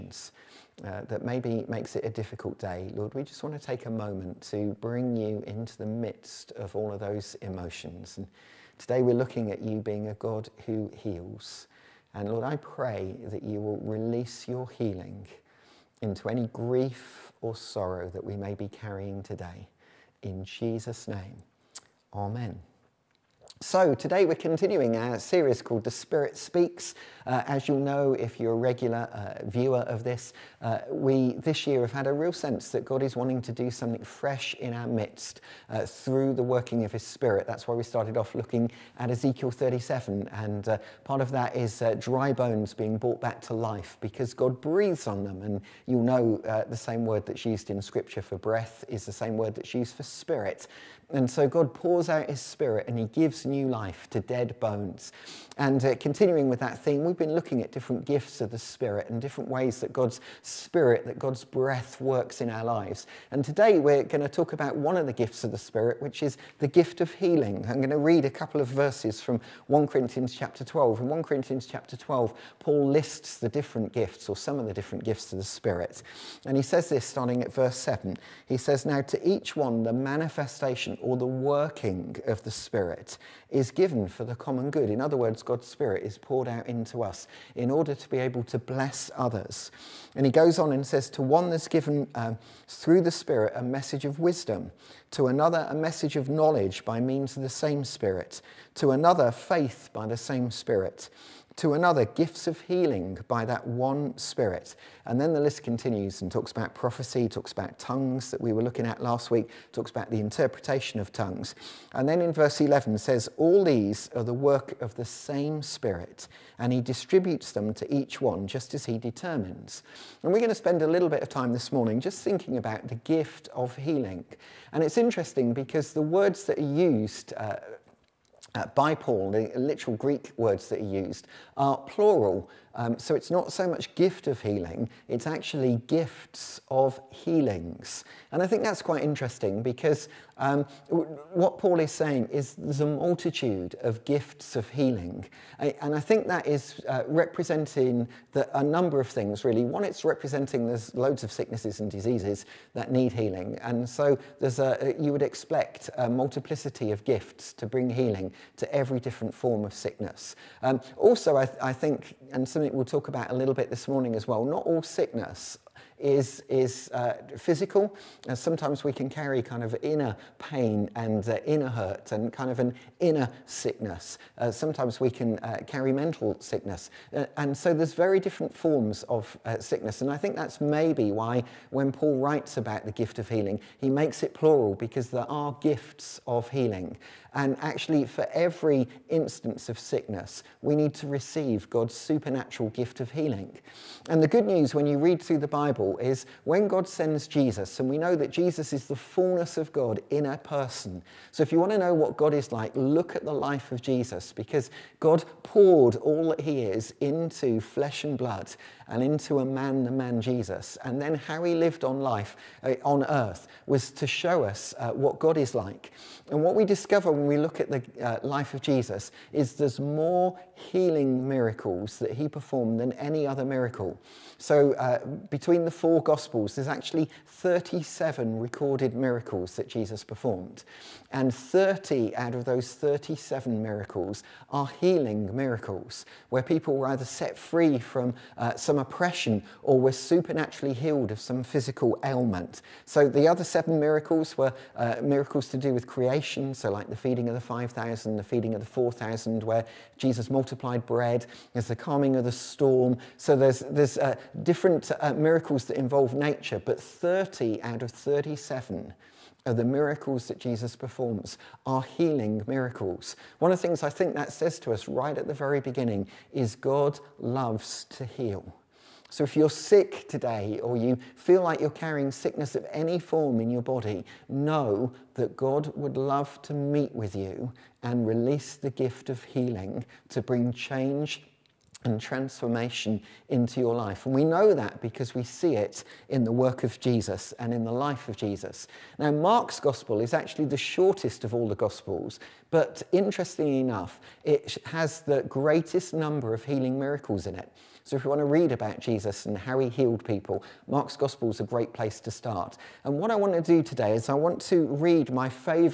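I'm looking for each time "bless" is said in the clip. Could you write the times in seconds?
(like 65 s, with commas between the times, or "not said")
88 s.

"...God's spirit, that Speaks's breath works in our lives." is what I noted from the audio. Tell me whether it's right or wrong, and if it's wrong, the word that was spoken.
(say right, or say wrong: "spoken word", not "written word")
wrong: "God", not "Speaks".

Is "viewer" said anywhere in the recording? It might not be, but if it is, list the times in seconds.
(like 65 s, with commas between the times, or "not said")
29 s.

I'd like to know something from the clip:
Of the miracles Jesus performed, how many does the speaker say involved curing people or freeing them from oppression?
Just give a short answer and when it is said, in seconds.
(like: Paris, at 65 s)
30, at 231 s.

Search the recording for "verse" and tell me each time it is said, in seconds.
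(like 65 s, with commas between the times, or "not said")
68 s, 77 s, 112 s.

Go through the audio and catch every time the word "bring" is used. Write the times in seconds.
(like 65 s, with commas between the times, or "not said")
4 s, 157 s, 280 s.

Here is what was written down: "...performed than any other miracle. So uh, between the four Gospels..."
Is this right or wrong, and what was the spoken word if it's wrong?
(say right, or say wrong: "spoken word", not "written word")
right.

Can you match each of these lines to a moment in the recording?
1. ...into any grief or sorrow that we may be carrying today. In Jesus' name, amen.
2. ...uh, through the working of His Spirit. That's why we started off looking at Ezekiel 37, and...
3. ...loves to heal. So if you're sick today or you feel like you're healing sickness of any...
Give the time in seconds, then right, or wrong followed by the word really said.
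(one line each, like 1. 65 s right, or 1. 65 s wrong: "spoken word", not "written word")
1. 16 s right
2. 35 s right
3. 267 s wrong: "carrying", not "healing".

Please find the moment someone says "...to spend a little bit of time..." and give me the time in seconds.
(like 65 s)
120 s.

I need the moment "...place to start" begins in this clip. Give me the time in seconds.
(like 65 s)
301 s.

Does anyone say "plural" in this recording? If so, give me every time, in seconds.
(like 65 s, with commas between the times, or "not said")
131 s, 184 s.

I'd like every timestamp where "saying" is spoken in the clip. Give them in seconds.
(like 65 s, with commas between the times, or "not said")
141 s.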